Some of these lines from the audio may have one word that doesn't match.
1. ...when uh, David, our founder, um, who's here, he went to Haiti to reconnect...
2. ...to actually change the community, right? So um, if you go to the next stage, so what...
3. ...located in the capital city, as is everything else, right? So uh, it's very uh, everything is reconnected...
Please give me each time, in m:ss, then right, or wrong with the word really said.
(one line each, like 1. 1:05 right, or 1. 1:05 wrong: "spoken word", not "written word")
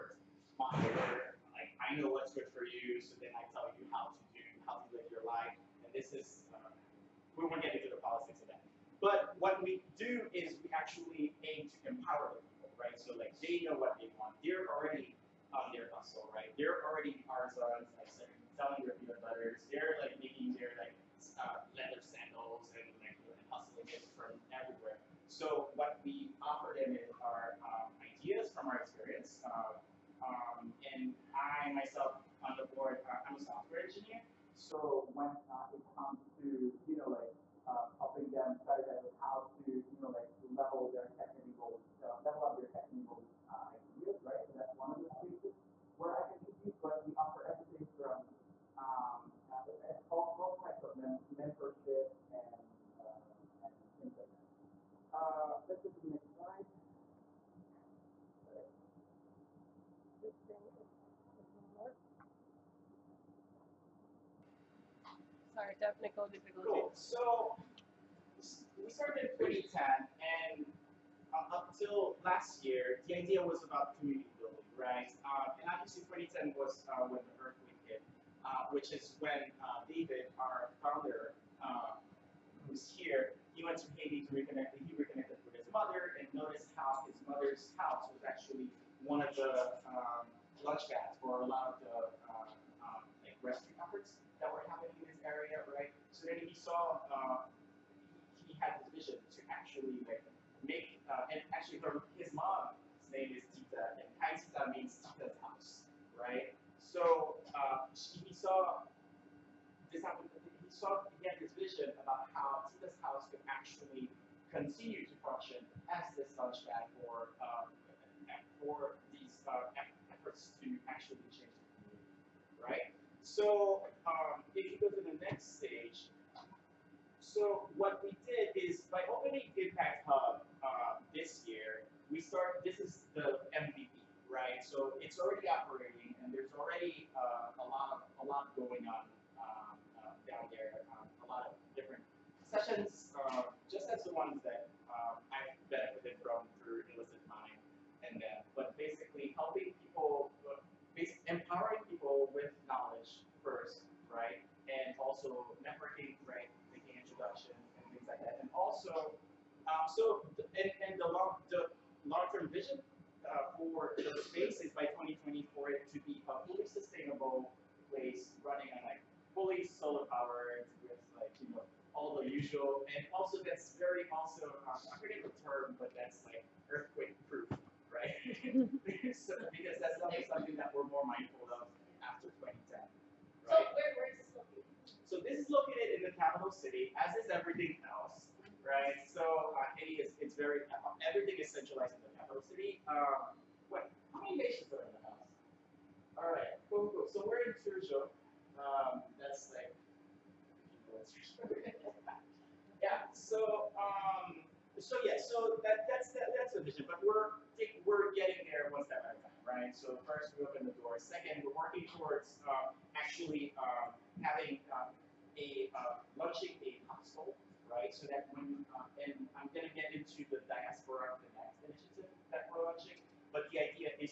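1. 1:19 right
2. 2:00 right
3. 3:05 wrong: "centralized", not "reconnected".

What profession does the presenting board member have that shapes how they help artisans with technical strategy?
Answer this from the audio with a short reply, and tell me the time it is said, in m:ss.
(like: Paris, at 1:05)
Software engineer, at 0:33.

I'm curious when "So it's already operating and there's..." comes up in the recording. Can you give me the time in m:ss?
2:14.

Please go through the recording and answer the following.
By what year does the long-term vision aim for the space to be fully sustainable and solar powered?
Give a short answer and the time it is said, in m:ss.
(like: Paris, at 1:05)
2020, at 2:44.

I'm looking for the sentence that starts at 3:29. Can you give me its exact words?
So first, we open the door.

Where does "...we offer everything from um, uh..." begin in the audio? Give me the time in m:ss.
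0:47.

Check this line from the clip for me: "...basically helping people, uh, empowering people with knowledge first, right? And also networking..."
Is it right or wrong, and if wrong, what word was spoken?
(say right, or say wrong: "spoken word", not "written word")
right.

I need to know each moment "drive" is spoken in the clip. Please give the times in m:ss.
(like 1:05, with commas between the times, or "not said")
not said.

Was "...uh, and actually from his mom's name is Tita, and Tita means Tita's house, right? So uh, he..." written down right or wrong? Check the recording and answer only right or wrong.
right.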